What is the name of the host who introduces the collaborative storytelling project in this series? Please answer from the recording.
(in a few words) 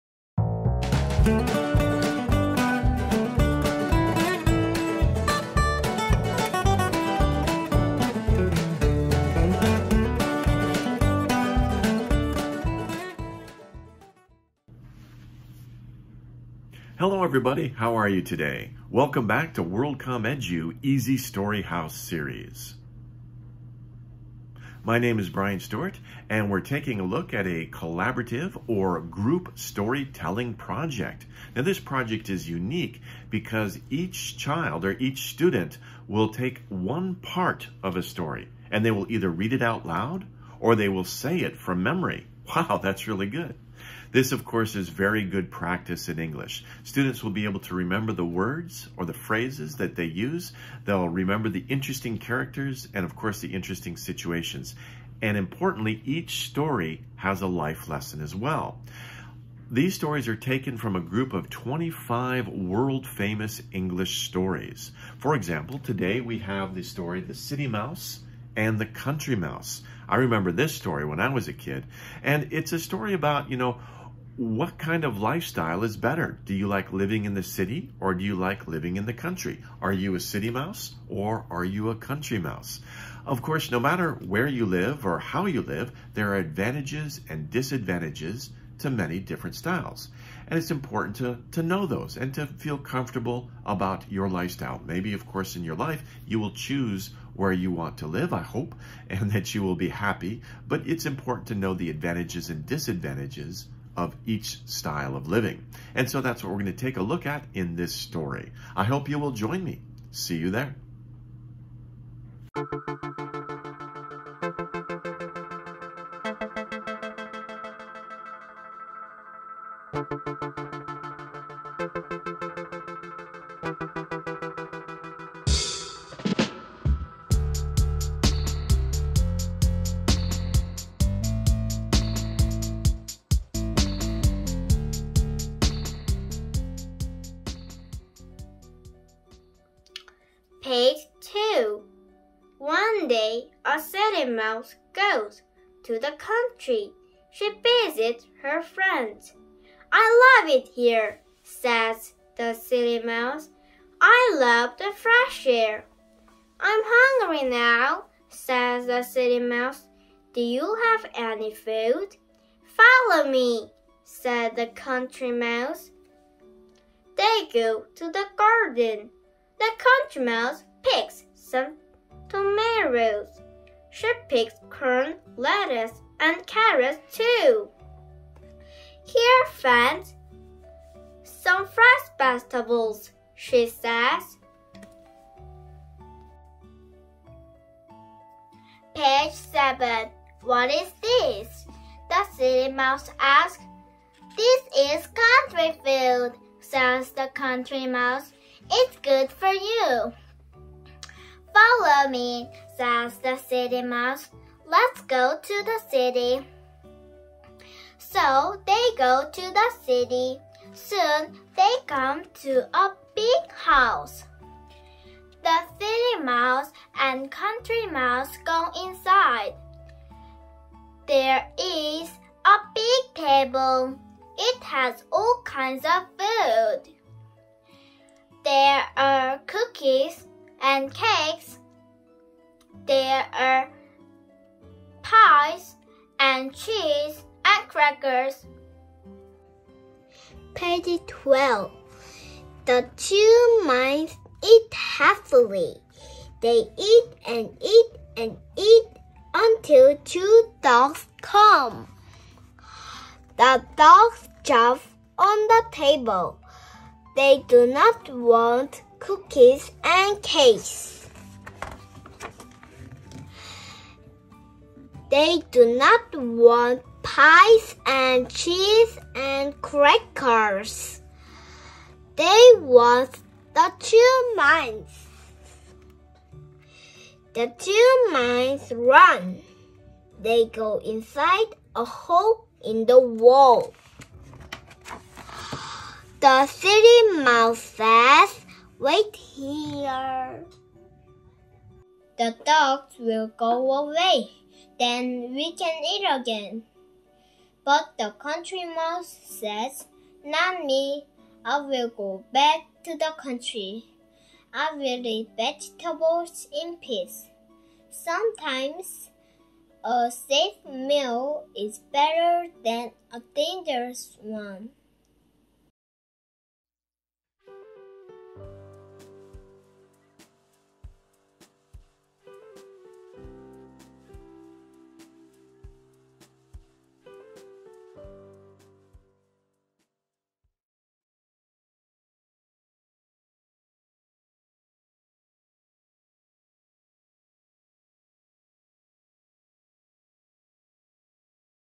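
Brian Stuart.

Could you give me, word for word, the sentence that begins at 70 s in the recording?
I remember this story when I was a kid.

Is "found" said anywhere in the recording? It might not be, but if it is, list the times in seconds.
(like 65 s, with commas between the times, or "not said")
not said.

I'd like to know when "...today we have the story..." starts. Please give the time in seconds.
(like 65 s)
65 s.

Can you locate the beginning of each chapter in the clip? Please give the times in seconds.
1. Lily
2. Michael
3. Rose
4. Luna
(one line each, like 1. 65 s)
1. 239 s
2. 291 s
3. 137 s
4. 186 s.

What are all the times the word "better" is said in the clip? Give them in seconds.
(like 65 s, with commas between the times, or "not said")
75 s, 311 s.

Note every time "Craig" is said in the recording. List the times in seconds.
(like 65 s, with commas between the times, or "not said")
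not said.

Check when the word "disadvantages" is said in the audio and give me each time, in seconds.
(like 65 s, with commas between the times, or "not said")
87 s, 102 s.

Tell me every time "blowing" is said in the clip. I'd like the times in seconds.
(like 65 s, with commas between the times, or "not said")
not said.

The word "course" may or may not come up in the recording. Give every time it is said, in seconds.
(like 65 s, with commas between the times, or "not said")
44 s, 53 s, 83 s, 95 s.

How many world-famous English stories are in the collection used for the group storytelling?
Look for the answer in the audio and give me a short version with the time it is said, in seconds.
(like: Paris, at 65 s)
25, at 61 s.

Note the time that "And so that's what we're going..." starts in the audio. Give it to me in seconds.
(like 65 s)
105 s.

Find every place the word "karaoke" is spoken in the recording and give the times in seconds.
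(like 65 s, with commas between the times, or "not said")
not said.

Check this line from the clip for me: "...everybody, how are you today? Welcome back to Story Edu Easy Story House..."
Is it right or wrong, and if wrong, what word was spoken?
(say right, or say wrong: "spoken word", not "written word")
wrong: "WorldCom", not "Story".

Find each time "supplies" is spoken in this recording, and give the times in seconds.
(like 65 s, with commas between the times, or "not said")
not said.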